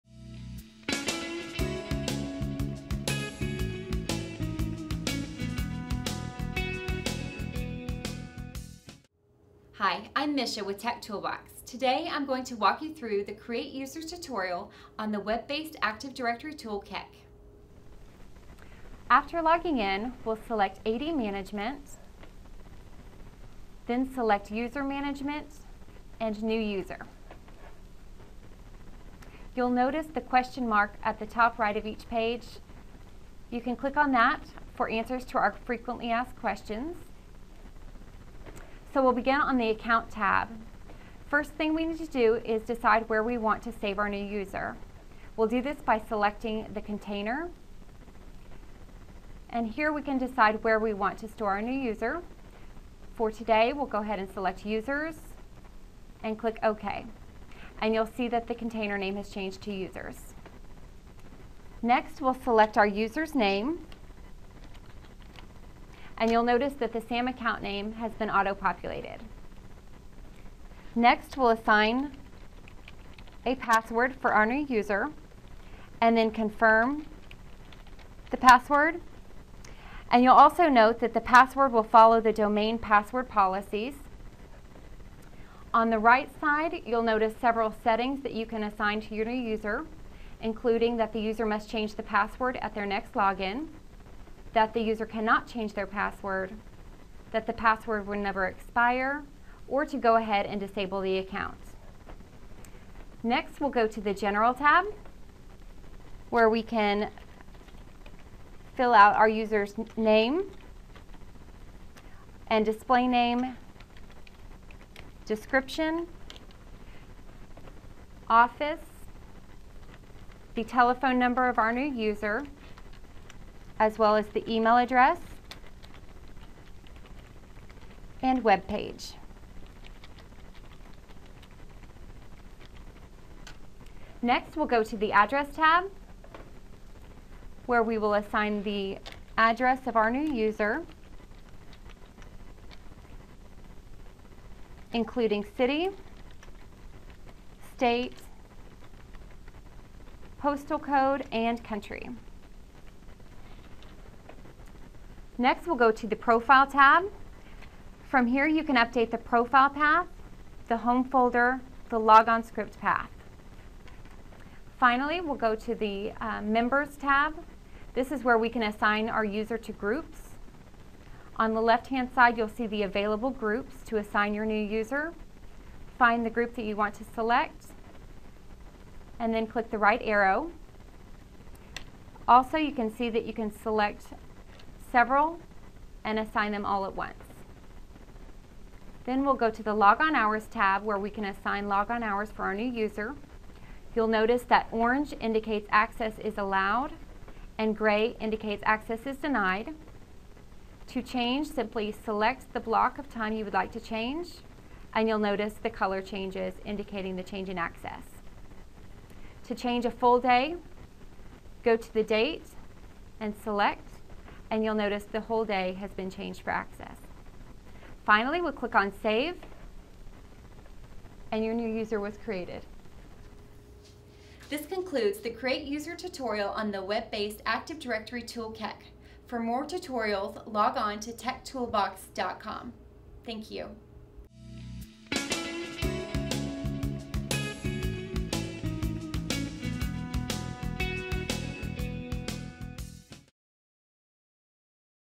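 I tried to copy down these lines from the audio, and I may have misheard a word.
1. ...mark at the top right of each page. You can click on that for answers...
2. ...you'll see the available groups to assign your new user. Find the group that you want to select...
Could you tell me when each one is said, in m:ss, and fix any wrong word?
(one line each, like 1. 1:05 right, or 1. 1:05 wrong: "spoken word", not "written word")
1. 0:30 right
2. 2:52 right.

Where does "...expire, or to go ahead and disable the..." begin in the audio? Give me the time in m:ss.
1:38.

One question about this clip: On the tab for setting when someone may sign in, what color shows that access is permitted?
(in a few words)
Orange.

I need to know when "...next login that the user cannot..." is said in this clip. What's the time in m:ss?
1:32.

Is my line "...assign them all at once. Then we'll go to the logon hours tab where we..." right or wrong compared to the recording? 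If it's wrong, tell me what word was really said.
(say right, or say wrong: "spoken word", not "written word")
right.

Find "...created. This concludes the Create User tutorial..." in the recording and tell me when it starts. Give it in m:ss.
3:42.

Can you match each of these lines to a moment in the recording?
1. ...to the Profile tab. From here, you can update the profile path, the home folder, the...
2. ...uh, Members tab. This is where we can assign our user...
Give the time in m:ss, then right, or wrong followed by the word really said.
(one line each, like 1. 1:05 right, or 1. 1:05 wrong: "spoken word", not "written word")
1. 2:35 right
2. 2:46 right.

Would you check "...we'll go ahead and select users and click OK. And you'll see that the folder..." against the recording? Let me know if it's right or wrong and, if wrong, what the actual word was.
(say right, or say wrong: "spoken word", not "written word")
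wrong: "container", not "folder".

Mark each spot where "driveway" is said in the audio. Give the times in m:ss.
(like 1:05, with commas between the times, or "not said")
not said.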